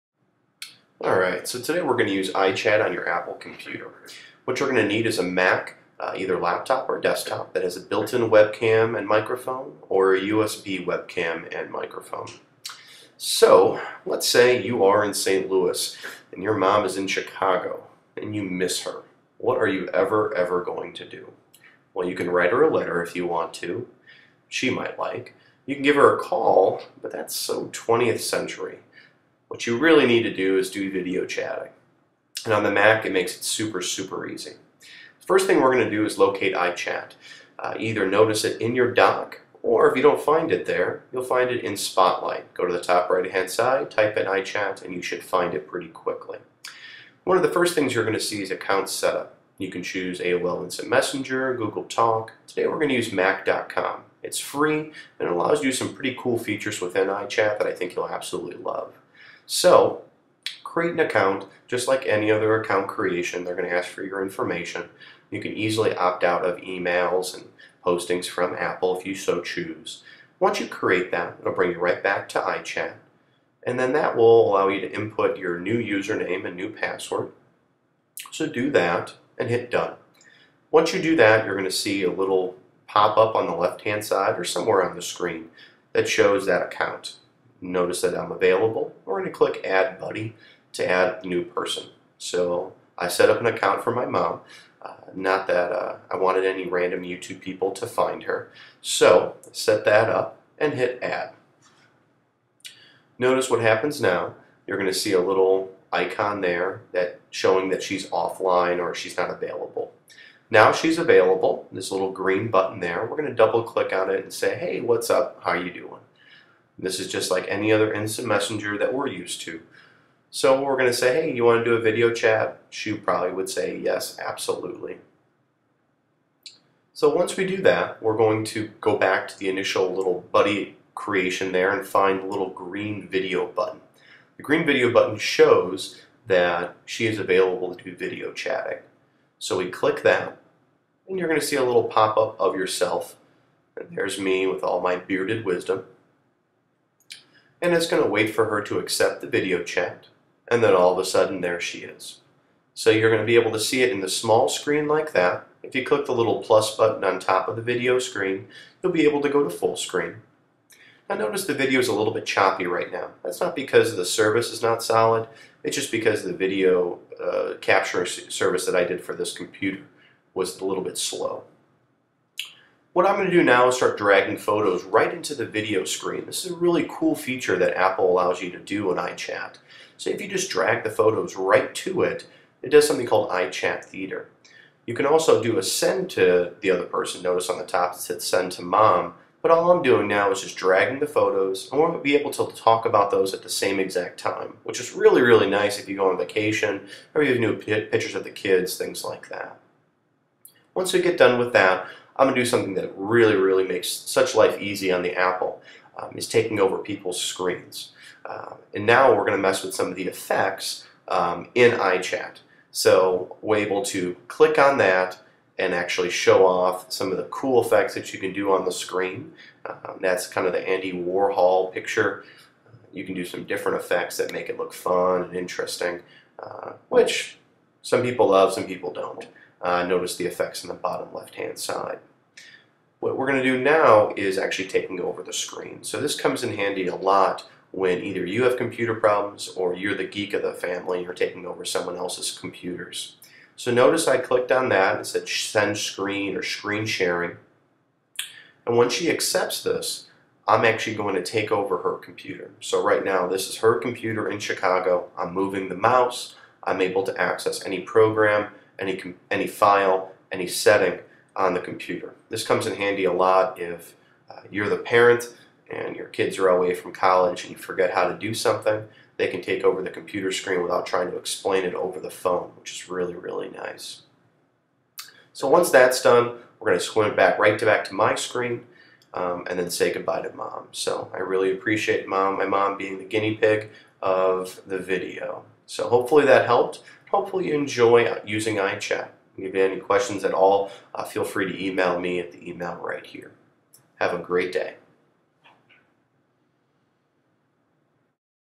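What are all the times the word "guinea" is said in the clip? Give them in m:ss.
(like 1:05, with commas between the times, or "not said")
4:43.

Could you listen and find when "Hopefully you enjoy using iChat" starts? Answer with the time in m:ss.
4:47.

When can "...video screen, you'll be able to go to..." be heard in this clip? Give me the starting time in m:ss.
2:37.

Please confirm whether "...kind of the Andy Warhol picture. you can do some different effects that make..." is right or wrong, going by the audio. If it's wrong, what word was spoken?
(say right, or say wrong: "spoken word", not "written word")
right.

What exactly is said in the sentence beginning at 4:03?
So notice I clicked on that and said send screen or screen sharing.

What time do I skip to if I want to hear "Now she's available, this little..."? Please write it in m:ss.
1:50.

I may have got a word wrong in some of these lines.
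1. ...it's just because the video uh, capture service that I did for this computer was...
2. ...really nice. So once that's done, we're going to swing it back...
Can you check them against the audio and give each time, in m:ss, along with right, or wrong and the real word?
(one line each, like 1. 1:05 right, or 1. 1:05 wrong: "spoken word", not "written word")
1. 2:45 right
2. 4:33 right.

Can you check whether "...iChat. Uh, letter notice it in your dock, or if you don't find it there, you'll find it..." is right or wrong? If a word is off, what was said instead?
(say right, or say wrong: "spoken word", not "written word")
wrong: "either", not "letter".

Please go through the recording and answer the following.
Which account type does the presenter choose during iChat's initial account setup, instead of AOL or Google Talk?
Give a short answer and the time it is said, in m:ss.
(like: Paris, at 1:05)
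Mac.com, at 0:53.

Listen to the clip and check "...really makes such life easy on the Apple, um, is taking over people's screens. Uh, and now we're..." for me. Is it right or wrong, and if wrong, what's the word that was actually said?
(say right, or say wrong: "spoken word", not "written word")
right.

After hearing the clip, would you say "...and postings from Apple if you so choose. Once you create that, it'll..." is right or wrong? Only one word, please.
right.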